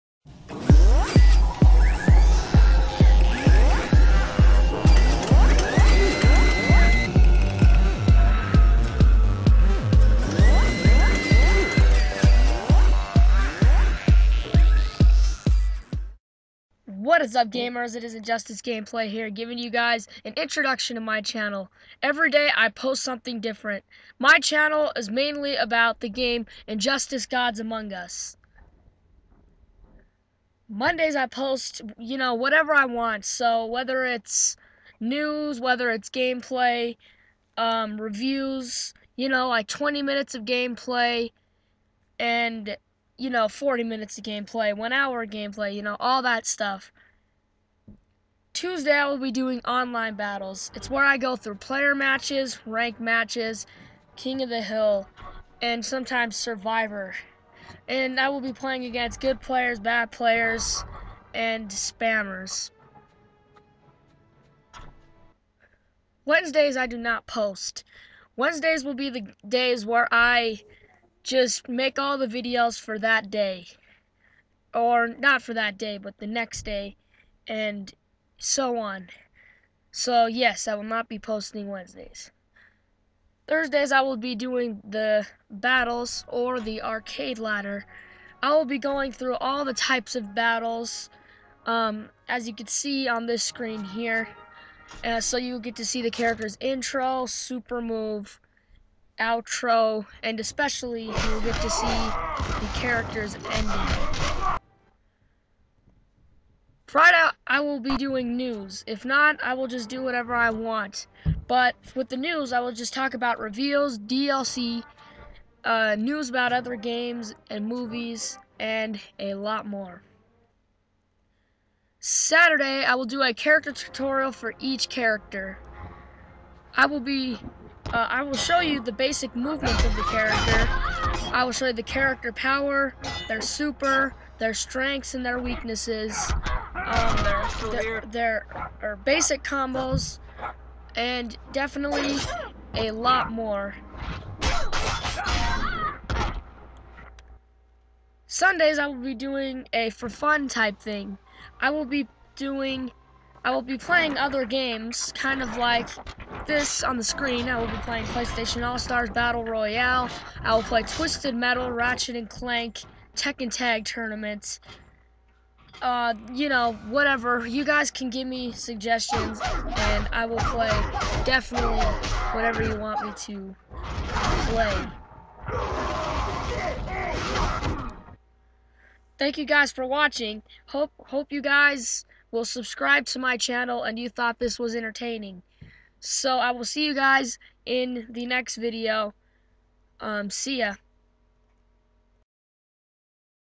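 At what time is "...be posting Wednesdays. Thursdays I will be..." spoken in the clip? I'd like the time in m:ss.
1:21.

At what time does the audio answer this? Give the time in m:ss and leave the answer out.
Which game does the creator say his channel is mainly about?
0:26.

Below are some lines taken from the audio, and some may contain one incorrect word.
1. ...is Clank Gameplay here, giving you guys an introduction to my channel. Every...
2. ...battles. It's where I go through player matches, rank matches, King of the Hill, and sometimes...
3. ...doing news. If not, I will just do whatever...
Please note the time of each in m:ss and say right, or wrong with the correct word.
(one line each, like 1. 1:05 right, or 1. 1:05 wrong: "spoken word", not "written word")
1. 0:18 wrong: "Injustice", not "Clank"
2. 0:50 right
3. 1:47 right.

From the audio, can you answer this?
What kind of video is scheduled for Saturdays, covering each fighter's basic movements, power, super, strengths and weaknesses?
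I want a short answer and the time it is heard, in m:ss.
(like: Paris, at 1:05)
Character tutorial, at 2:03.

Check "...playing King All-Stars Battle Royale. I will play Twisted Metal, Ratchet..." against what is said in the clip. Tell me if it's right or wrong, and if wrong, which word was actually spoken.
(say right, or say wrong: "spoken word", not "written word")
wrong: "PlayStation", not "King".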